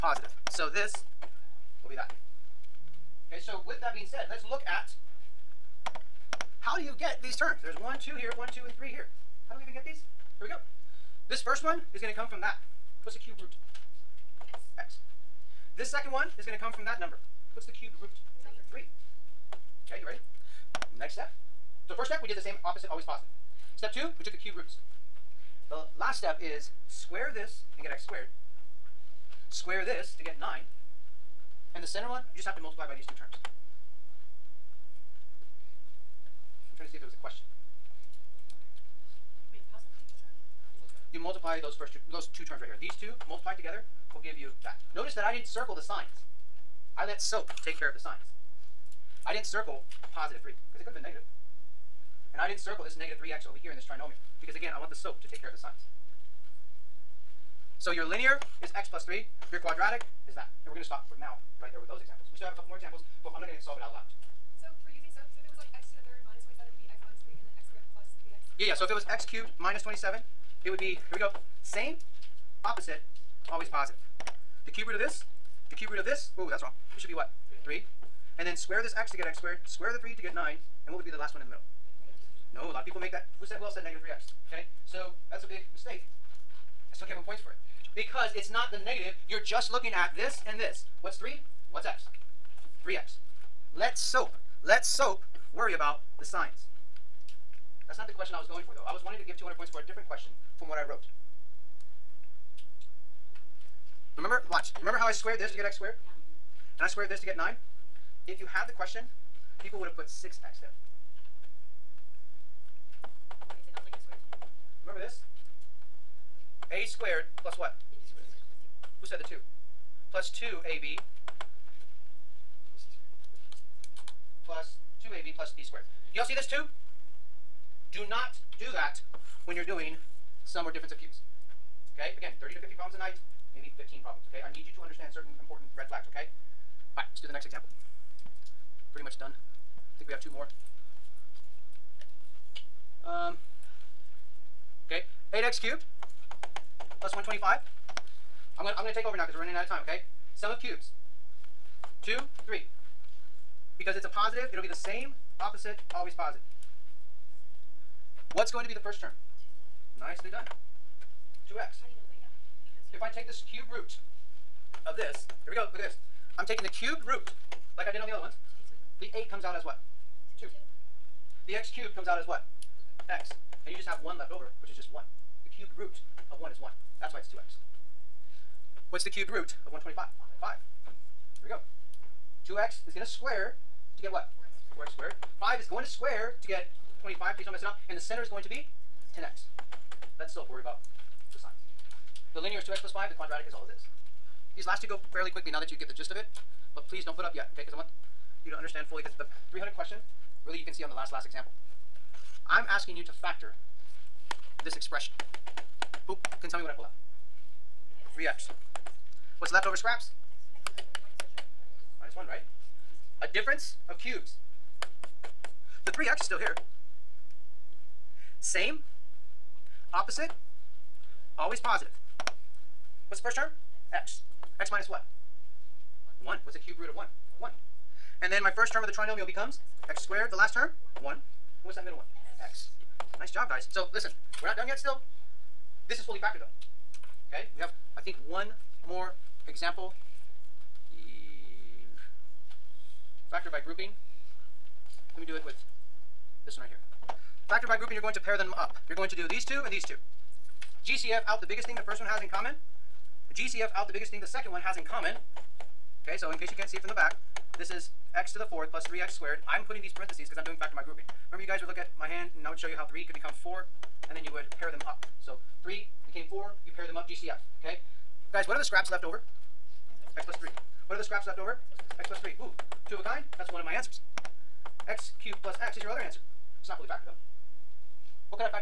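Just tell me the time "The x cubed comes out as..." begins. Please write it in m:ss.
2:51.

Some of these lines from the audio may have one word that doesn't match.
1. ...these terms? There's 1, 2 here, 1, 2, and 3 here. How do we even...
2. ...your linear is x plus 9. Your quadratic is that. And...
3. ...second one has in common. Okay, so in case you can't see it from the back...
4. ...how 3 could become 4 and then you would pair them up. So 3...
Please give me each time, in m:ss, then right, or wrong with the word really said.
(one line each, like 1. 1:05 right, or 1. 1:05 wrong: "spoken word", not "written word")
1. 0:07 right
2. 0:57 wrong: "3", not "9"
3. 4:14 right
4. 4:22 right.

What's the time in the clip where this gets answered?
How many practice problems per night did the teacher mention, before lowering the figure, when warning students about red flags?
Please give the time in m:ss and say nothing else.
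2:12.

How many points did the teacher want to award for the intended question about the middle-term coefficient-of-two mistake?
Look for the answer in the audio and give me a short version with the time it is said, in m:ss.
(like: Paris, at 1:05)
200, at 1:39.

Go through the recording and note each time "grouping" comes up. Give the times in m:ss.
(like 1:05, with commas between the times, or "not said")
4:03, 4:07, 4:20.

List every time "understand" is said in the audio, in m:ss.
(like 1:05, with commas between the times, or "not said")
2:14, 3:18.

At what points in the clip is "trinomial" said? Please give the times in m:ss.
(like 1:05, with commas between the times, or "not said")
0:53, 3:48.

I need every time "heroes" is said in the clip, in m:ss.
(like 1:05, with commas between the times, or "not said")
not said.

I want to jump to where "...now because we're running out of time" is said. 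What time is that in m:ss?
2:29.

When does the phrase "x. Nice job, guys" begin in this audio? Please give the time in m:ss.
3:52.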